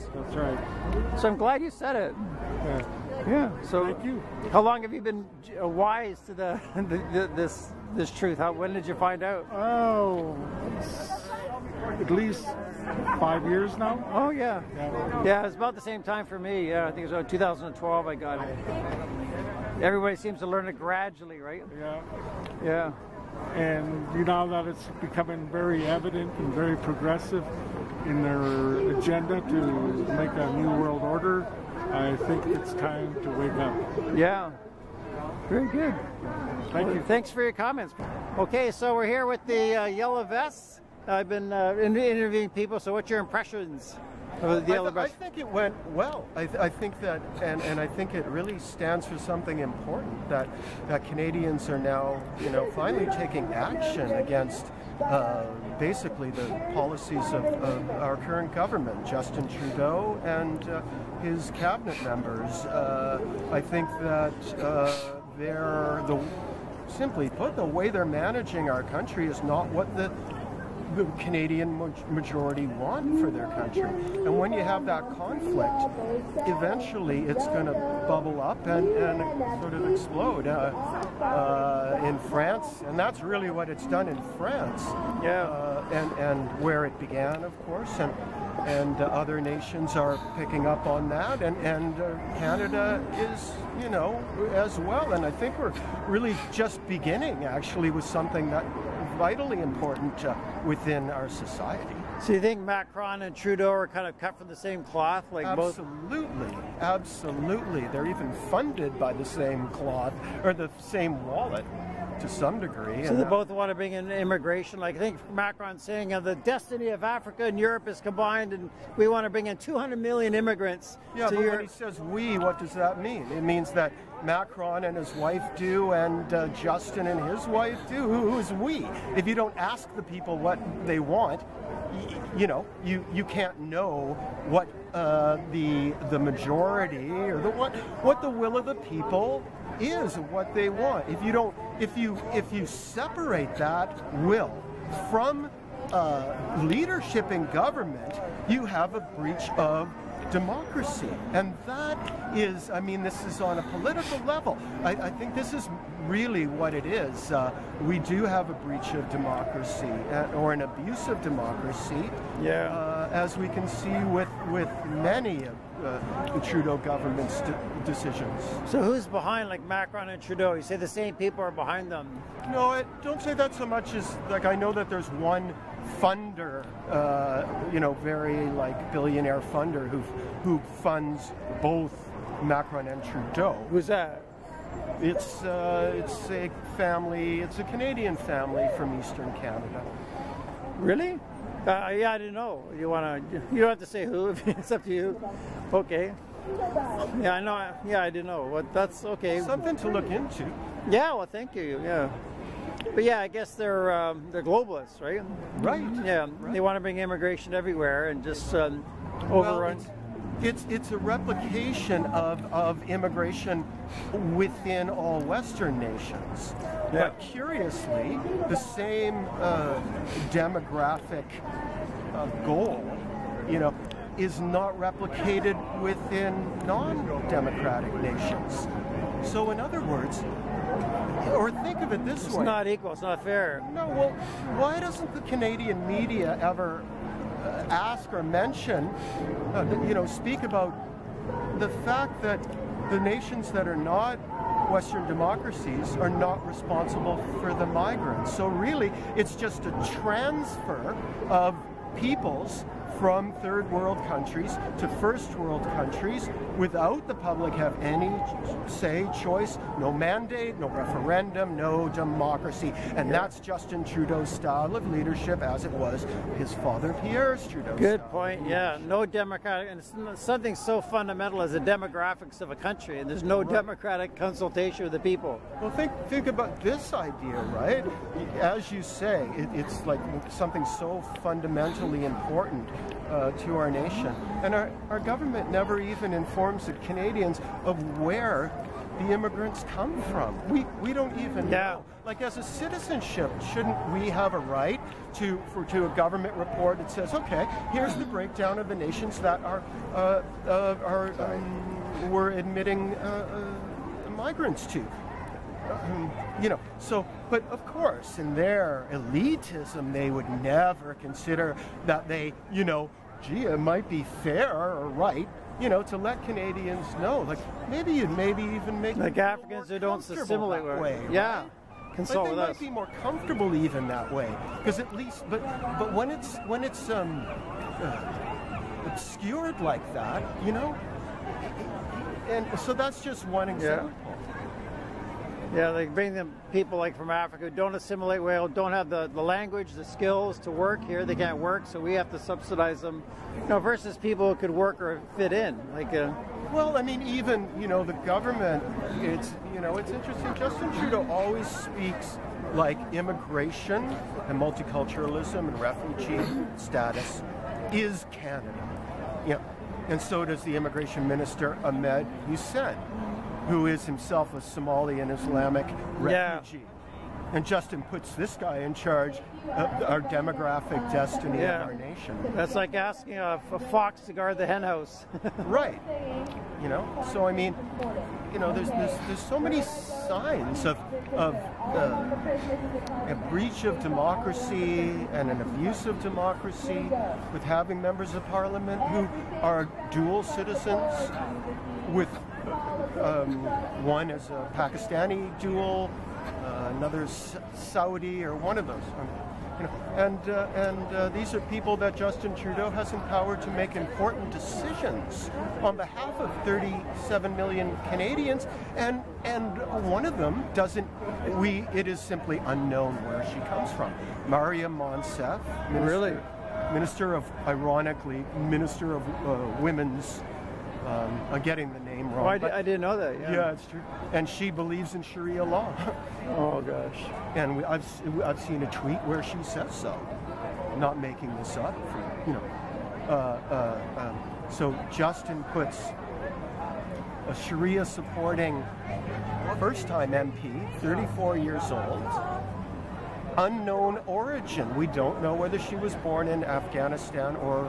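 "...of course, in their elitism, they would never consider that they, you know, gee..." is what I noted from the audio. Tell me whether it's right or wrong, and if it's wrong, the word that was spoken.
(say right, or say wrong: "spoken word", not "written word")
right.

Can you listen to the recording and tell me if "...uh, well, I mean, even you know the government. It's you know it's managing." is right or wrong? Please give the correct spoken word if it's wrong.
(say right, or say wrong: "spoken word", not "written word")
wrong: "interesting", not "managing".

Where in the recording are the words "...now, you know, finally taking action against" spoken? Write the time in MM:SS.
00:51.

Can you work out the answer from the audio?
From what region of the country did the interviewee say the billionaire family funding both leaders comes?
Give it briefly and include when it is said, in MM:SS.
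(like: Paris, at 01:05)
Eastern Canada, at 03:08.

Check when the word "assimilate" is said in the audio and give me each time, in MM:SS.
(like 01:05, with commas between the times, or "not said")
05:20, 05:37.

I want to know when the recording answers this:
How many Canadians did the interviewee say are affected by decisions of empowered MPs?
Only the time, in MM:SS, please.
06:46.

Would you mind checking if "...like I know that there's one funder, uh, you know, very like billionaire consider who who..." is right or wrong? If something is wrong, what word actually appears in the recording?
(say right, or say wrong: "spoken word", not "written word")
wrong: "funder", not "consider".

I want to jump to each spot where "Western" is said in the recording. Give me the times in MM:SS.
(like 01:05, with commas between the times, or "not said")
03:35, 04:04.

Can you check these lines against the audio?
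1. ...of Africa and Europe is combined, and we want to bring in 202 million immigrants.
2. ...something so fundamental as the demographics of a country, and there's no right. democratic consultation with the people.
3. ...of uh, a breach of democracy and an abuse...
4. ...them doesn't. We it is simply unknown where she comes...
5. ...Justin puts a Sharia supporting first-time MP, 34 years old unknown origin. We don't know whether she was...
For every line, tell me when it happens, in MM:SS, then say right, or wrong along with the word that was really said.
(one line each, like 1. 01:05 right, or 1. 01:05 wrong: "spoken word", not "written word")
1. 01:56 wrong: "200", not "202"
2. 04:30 right
3. 06:21 right
4. 06:50 right
5. 07:14 right.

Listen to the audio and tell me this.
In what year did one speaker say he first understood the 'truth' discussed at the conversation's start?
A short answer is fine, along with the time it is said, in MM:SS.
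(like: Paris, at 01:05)
2012, at 00:17.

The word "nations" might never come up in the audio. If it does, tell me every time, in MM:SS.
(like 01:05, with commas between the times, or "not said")
01:29, 03:35, 03:48, 04:02, 04:43, 04:58, 06:11.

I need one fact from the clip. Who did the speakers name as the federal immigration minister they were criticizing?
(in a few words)
Ahmed Hussen.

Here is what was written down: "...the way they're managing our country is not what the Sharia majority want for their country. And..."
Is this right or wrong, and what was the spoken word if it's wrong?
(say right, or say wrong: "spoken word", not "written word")
wrong: "Canadian", not "Sharia".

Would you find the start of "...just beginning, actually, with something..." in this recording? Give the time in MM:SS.
01:36.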